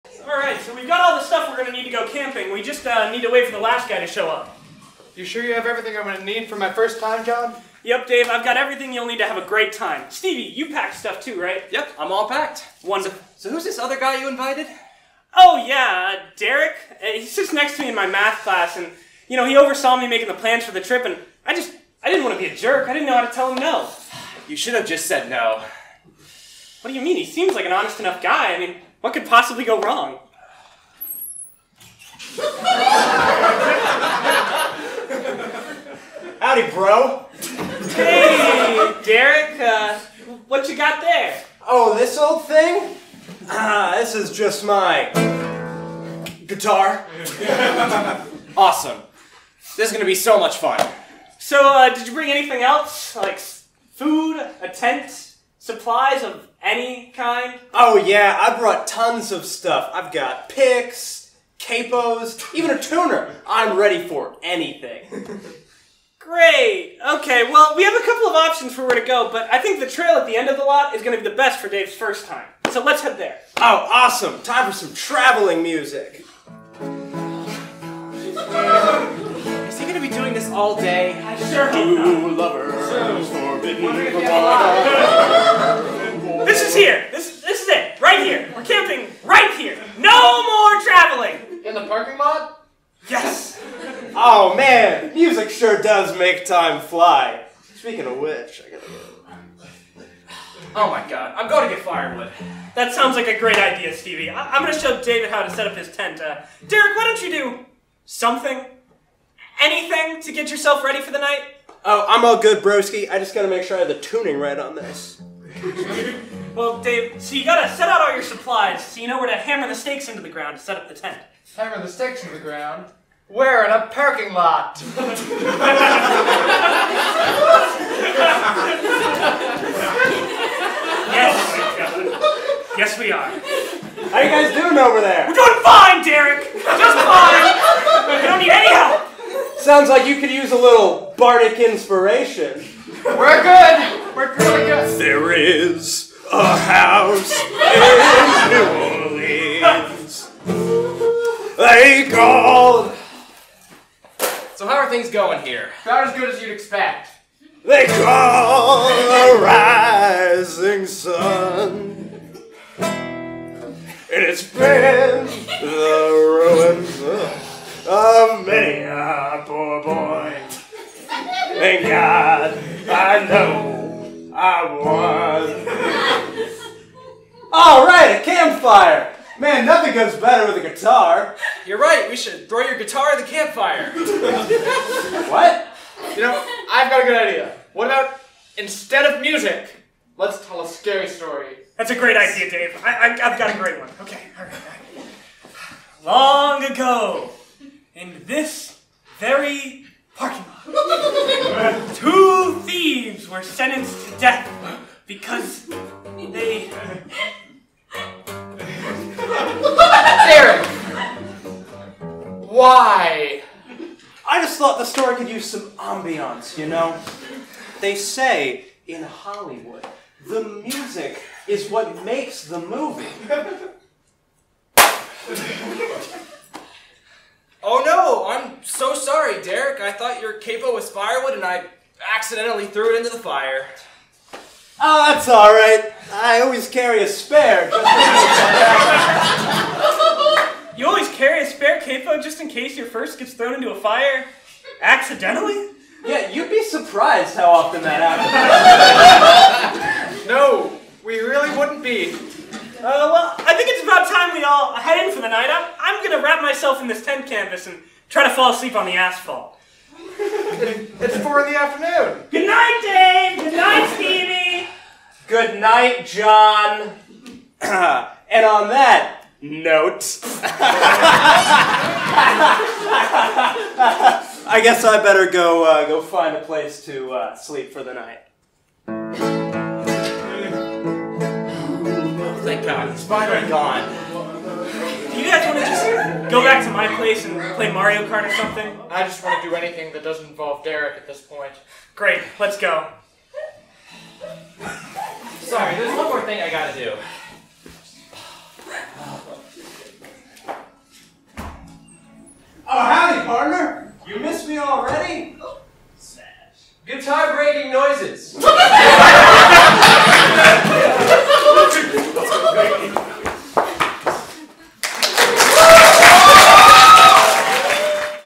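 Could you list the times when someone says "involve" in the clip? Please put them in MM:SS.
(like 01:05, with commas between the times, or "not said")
04:50.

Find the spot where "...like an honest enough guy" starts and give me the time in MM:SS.
00:27.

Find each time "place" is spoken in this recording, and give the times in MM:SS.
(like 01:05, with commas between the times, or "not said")
04:36, 04:46.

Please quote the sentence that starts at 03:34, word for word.
I just thought the story could use some ambiance, you know?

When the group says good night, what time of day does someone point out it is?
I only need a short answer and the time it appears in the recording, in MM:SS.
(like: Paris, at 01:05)
Four in the afternoon, at 04:21.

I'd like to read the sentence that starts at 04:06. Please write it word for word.
Yeah, you'd be surprised how often that happens.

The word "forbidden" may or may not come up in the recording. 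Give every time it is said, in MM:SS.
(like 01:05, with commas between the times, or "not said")
01:23.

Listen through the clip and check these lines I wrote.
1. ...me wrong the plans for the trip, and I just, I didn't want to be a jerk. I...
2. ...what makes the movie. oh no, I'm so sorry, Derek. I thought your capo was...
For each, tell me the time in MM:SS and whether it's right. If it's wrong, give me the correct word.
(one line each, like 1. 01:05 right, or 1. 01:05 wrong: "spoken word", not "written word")
1. 00:19 wrong: "making", not "wrong"
2. 03:41 right.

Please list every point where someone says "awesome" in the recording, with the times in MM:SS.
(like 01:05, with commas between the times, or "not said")
00:48, 01:13.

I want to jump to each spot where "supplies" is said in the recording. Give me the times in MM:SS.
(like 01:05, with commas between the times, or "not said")
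00:55, 01:58.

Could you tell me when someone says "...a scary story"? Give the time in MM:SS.
03:10.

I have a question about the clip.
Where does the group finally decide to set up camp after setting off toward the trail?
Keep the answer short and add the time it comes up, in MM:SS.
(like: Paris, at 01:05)
The parking lot, at 01:31.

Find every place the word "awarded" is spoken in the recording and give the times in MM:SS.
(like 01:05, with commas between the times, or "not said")
not said.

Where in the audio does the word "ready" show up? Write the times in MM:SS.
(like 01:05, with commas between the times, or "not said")
01:03, 01:50.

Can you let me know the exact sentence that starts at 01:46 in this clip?
Uh, Derek, why don't you do something?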